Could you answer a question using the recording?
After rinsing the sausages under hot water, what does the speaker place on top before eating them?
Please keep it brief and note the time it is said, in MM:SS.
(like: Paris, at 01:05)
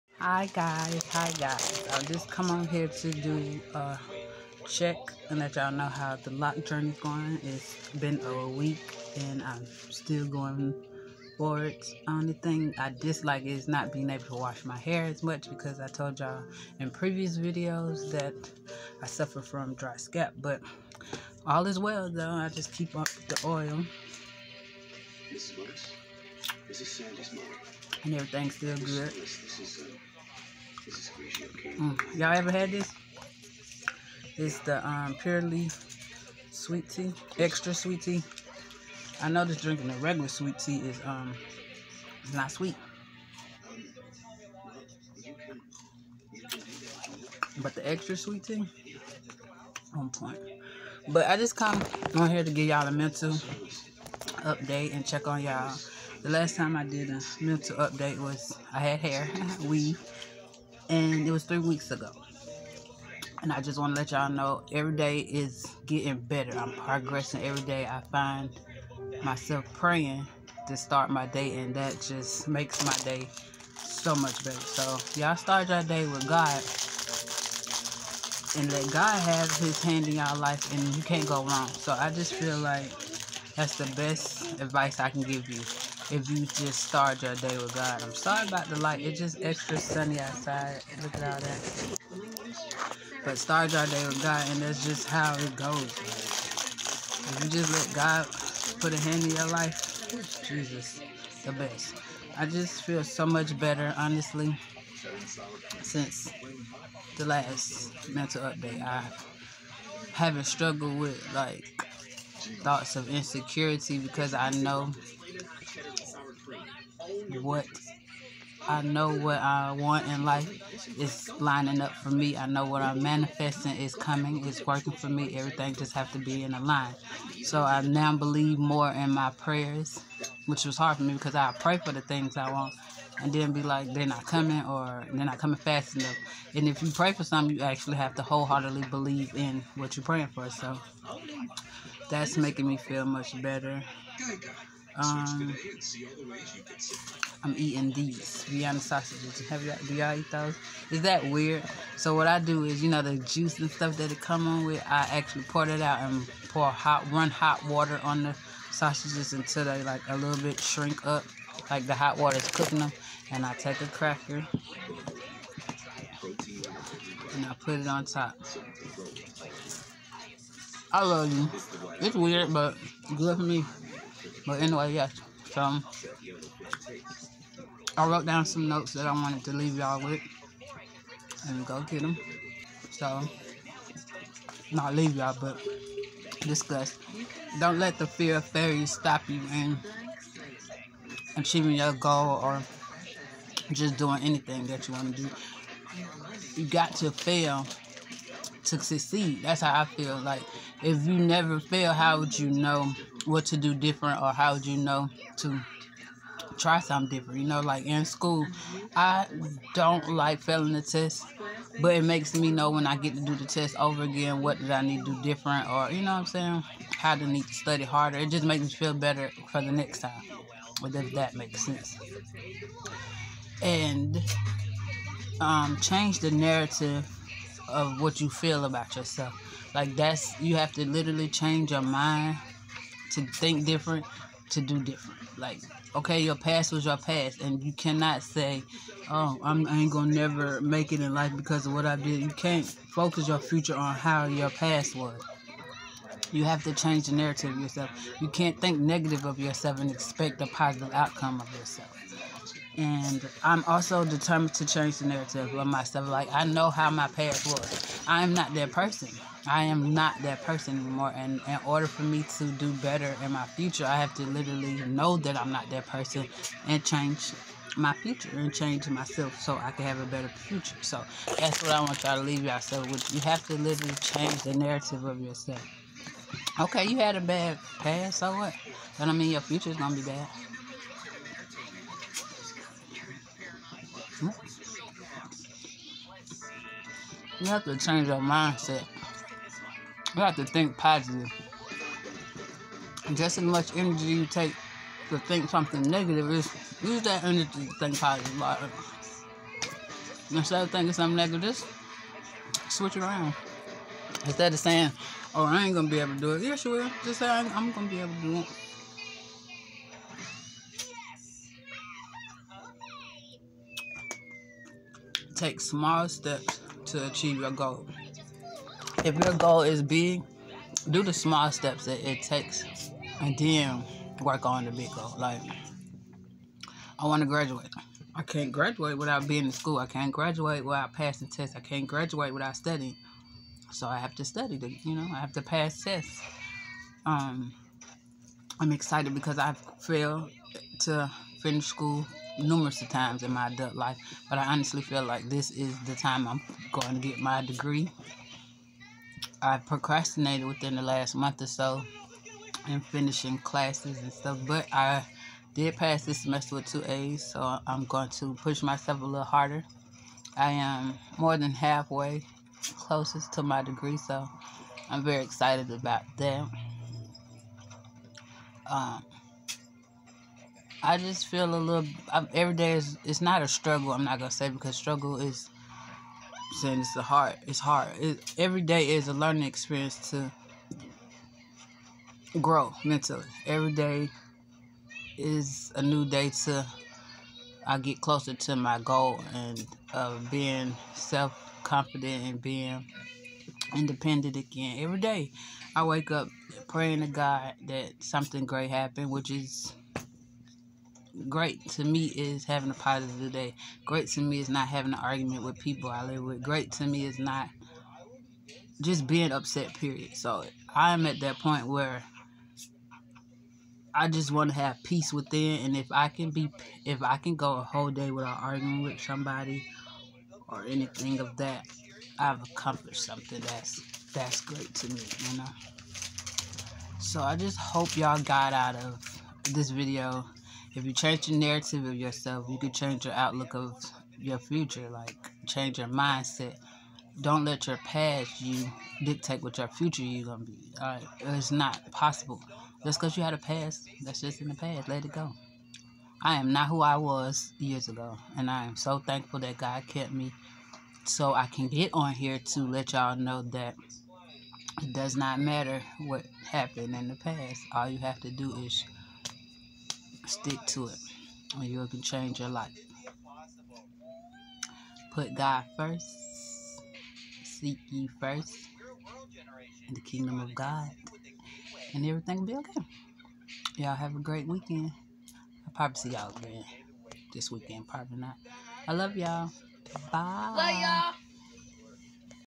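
A cracker, at 02:43.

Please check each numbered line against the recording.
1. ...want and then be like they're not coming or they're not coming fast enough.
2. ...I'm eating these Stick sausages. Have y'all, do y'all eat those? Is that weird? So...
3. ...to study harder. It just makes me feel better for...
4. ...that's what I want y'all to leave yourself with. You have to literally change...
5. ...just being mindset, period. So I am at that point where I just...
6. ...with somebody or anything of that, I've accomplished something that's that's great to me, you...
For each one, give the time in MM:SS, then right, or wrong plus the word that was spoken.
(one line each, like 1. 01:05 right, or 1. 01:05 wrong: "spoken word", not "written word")
1. 02:12 right
2. 02:27 wrong: "Vienna", not "Stick"
3. 03:37 right
4. 04:31 right
5. 06:48 wrong: "upset", not "mindset"
6. 06:58 right.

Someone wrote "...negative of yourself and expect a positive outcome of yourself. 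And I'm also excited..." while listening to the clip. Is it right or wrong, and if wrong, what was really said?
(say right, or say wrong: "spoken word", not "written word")
wrong: "determined", not "excited".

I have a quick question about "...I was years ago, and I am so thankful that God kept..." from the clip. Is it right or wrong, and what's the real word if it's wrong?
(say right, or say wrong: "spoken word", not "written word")
right.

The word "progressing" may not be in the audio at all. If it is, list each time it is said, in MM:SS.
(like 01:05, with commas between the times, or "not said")
01:06.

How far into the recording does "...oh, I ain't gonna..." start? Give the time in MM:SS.
05:05.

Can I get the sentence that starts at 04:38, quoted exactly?
But I mean your future's gonna be bad.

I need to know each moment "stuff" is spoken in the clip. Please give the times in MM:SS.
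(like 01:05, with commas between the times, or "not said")
02:33, 05:54.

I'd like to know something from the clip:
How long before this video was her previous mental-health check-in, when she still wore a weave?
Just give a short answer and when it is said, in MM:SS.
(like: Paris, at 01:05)
3 weeks, at 01:01.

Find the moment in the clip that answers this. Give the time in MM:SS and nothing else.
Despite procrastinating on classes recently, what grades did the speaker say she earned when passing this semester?
05:56.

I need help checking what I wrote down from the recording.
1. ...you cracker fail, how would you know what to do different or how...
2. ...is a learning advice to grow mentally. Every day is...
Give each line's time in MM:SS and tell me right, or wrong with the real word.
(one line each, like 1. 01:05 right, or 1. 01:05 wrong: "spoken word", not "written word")
1. 03:21 wrong: "never", not "cracker"
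2. 06:18 wrong: "experience", not "advice".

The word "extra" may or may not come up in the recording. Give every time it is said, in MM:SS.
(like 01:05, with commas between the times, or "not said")
00:37, 00:47, 01:29.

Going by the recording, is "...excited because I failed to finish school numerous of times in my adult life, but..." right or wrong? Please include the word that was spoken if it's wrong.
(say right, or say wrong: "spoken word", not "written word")
right.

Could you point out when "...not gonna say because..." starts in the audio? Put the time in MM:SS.
06:14.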